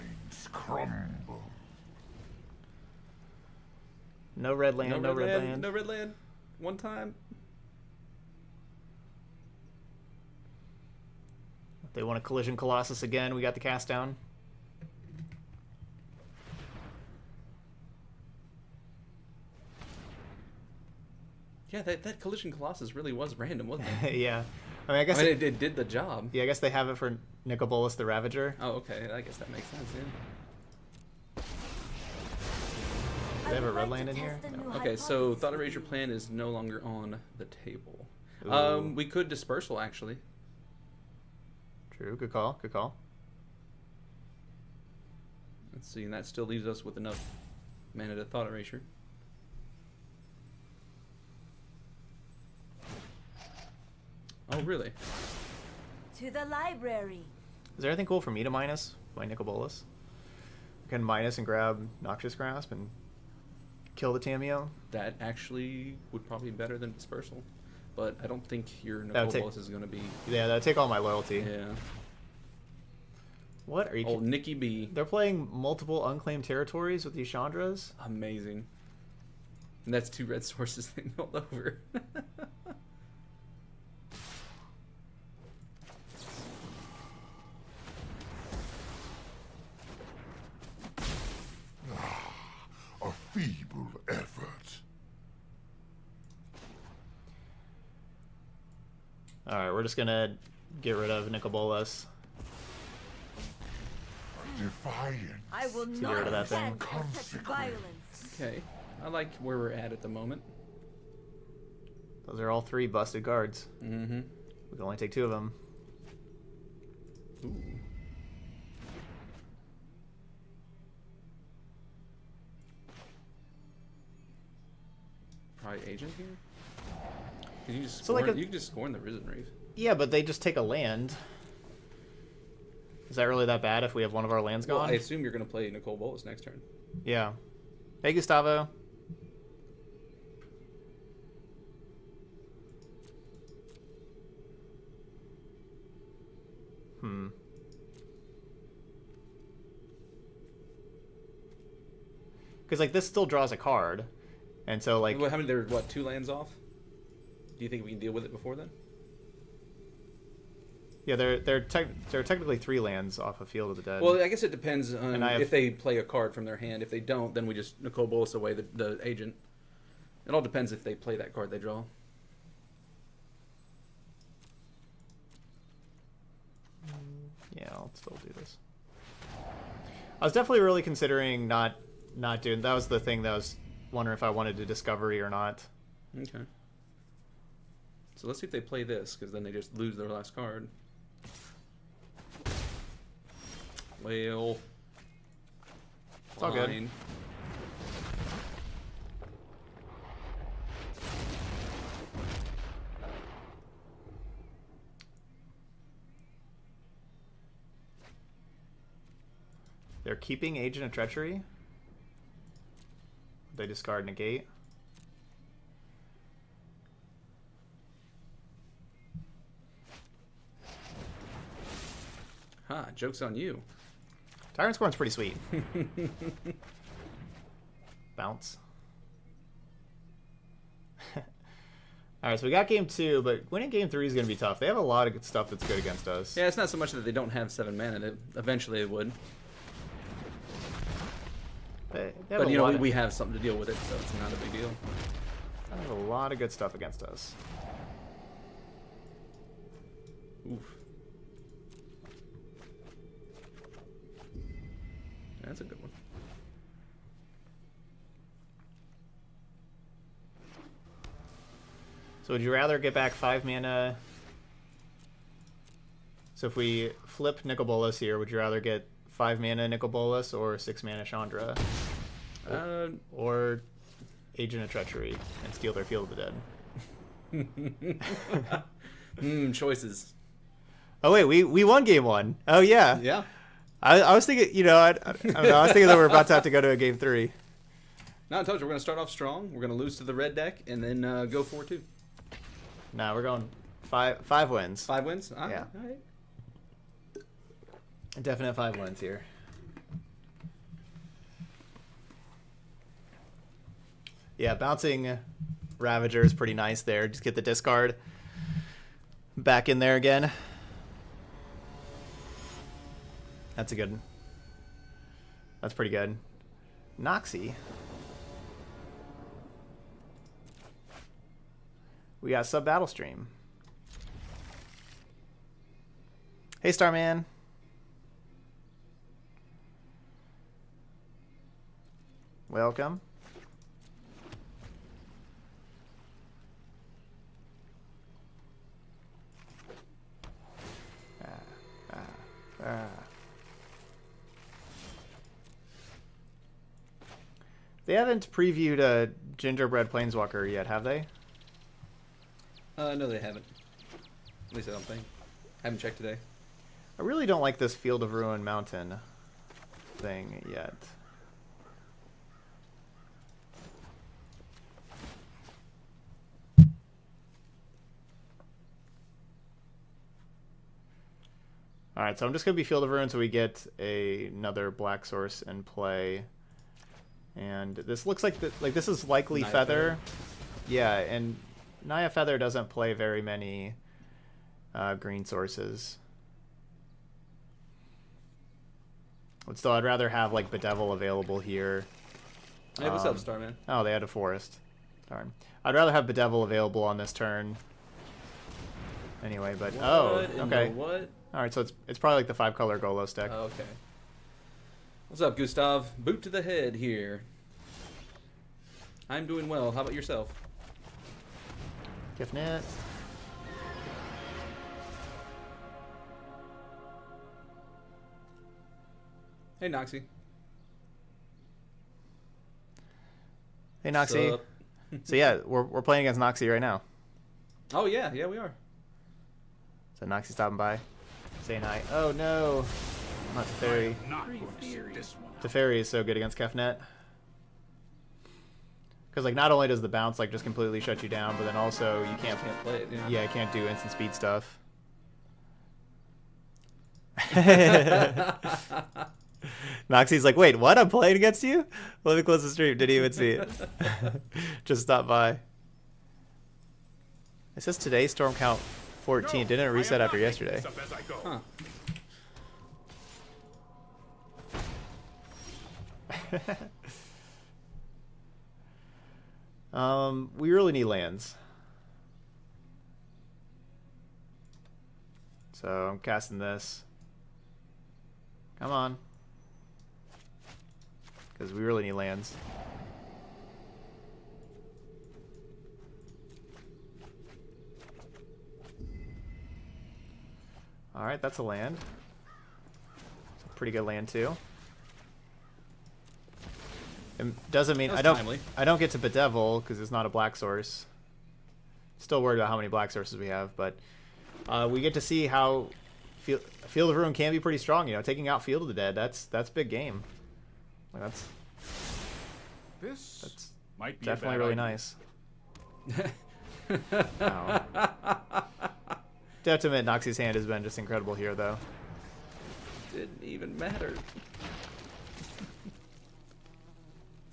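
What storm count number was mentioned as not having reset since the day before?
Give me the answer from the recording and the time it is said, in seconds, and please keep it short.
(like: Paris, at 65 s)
14, at 459 s.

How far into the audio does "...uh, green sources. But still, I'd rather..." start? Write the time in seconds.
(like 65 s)
384 s.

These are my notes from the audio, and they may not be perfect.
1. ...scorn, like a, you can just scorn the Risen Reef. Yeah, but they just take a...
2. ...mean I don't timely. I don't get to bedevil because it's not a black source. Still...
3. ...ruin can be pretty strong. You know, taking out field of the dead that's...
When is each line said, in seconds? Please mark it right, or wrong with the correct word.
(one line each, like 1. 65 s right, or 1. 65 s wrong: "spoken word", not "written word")
1. 128 s right
2. 497 s right
3. 506 s right.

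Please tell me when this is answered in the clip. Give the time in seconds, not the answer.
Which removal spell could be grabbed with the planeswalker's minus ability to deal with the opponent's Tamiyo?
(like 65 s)
62 s.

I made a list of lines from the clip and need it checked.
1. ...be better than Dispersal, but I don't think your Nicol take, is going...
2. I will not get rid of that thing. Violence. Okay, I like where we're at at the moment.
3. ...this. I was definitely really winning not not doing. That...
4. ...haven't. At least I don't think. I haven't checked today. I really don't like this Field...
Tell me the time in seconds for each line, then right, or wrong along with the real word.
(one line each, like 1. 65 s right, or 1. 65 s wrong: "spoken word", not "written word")
1. 66 s right
2. 105 s right
3. 178 s wrong: "considering", not "winning"
4. 353 s right.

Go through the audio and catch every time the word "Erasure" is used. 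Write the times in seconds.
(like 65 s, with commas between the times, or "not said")
35 s, 48 s.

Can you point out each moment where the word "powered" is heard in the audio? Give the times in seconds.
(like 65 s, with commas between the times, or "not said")
not said.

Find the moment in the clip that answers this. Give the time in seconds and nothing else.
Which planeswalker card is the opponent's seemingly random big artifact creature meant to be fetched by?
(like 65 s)
27 s.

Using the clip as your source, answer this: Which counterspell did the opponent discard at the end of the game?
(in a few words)
Negate.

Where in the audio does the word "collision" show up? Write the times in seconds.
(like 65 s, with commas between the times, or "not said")
12 s, 22 s.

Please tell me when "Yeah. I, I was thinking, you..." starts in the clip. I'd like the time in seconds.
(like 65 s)
283 s.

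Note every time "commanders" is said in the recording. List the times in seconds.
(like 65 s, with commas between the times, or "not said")
not said.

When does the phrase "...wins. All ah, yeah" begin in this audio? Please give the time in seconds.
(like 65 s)
295 s.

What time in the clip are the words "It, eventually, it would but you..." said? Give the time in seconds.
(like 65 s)
238 s.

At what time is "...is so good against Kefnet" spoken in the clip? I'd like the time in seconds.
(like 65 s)
435 s.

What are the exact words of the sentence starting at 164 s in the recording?
Well, I guess it depends on if they play a card from their hand.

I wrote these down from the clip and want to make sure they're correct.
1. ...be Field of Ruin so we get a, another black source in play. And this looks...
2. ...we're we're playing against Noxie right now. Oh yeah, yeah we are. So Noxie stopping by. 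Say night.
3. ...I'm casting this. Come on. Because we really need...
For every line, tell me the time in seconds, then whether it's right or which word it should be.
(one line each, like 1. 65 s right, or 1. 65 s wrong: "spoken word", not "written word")
1. 372 s right
2. 425 s right
3. 475 s right.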